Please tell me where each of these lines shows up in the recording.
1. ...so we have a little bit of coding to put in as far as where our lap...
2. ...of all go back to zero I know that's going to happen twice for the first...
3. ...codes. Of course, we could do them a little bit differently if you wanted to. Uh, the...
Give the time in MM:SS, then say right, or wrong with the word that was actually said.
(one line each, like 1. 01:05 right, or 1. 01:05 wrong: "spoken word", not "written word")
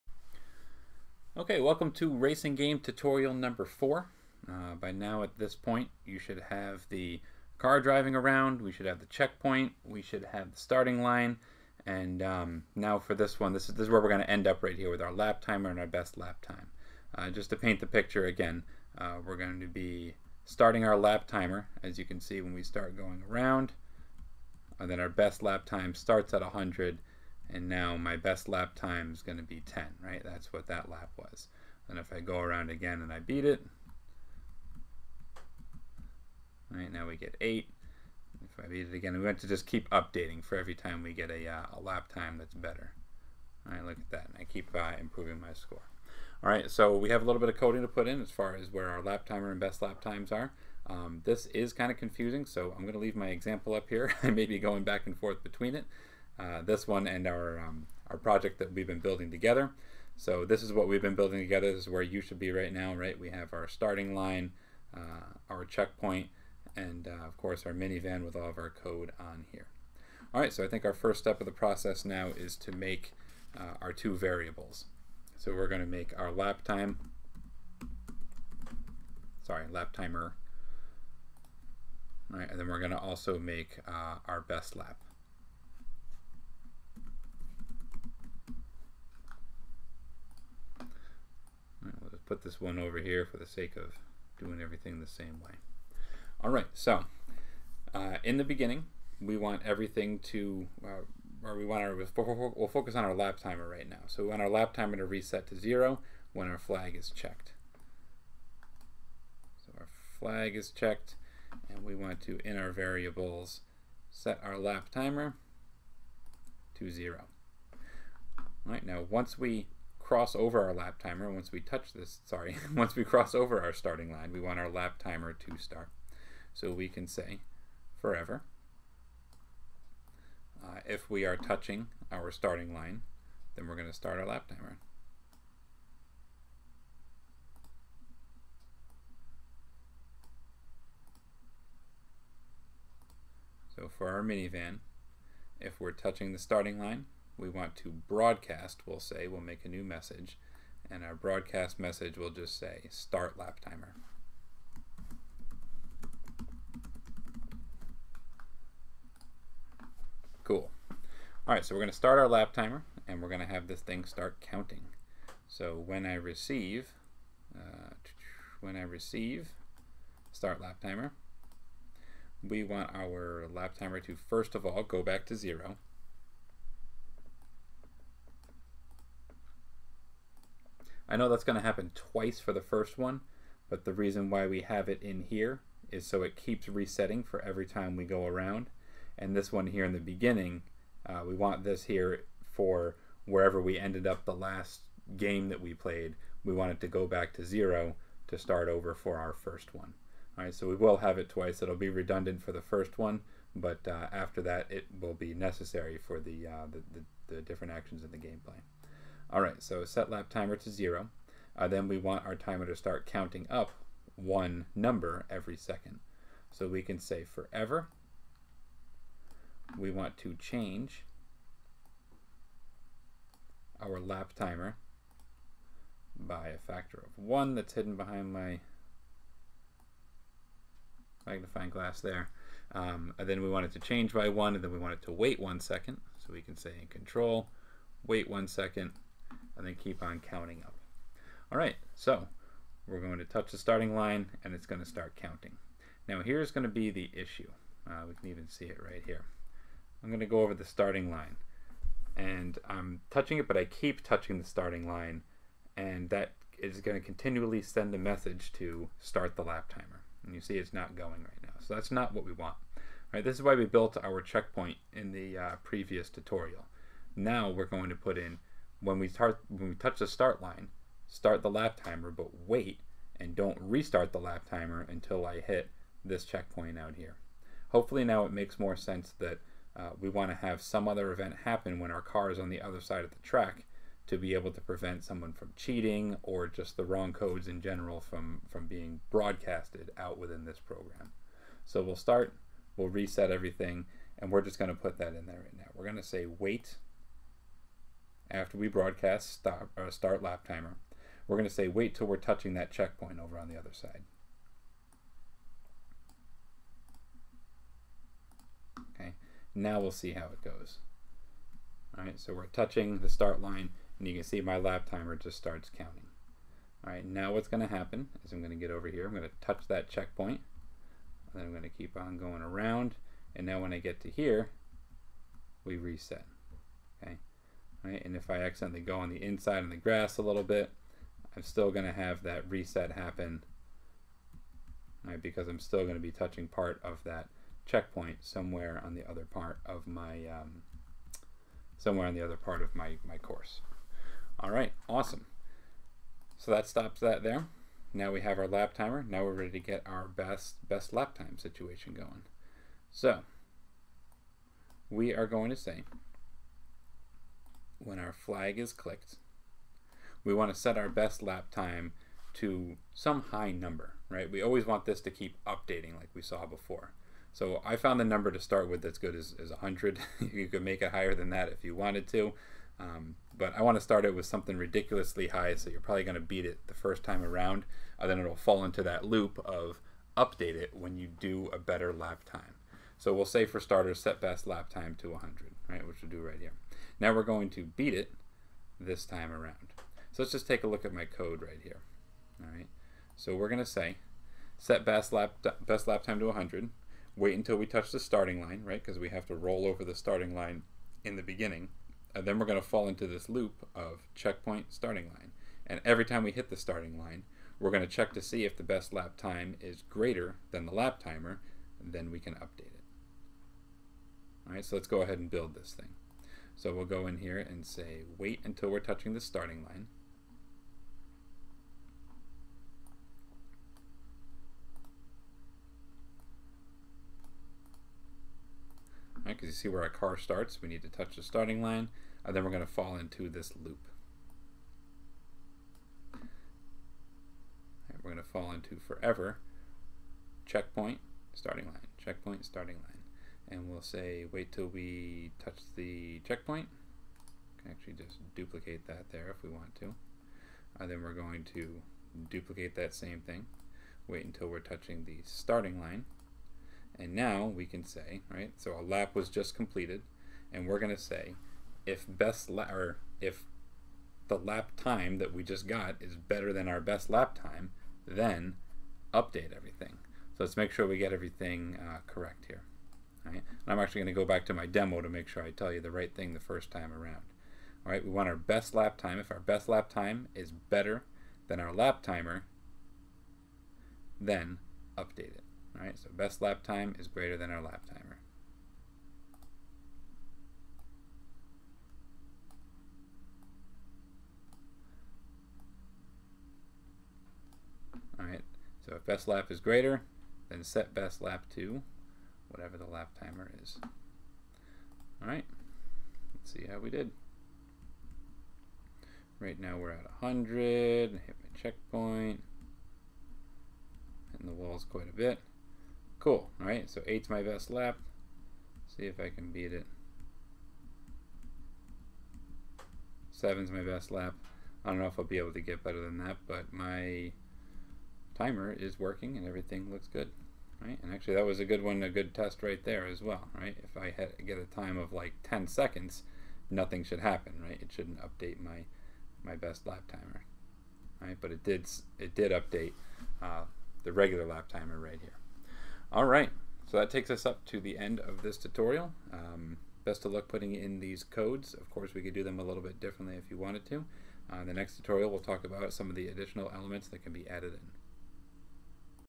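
1. 00:46 right
2. 02:54 right
3. 09:11 right.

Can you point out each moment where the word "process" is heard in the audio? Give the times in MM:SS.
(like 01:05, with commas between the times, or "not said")
01:11.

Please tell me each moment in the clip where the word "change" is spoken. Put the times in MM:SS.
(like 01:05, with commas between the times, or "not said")
03:40, 03:53.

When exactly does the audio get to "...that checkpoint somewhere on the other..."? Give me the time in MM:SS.
05:37.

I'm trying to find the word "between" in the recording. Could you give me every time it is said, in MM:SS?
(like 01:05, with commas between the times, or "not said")
00:55.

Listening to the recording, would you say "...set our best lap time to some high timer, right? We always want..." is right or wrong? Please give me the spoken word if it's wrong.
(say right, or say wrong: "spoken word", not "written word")
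wrong: "number", not "timer".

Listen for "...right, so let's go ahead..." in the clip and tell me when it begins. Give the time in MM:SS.
06:54.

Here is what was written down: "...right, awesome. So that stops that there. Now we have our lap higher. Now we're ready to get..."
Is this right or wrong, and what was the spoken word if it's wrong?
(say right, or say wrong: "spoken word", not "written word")
wrong: "timer", not "higher".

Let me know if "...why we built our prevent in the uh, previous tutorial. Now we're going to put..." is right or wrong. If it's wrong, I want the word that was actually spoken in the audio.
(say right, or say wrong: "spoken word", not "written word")
wrong: "checkpoint", not "prevent".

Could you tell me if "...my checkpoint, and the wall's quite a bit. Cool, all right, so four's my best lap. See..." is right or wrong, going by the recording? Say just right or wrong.
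wrong.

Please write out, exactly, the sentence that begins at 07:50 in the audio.
So let's make sure we get everything uh, correct here.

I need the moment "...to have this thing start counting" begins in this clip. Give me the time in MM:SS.
02:43.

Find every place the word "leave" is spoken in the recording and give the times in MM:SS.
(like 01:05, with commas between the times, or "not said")
00:52.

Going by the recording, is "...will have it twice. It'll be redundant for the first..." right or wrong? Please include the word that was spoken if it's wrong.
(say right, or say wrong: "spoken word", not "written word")
right.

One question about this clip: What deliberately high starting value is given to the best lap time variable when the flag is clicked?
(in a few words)
100.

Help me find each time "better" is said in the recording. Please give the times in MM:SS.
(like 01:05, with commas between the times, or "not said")
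00:42, 06:21, 07:46, 08:00, 08:45.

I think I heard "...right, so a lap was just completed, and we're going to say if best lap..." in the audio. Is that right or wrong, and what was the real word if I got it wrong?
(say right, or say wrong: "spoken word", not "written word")
right.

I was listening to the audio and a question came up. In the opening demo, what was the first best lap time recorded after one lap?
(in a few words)
10.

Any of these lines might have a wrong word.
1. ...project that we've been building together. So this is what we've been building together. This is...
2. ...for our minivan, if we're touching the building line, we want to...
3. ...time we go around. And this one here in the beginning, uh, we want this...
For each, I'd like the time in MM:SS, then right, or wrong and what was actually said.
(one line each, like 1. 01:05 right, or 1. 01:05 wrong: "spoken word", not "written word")
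1. 00:58 right
2. 02:23 wrong: "starting", not "building"
3. 03:07 right.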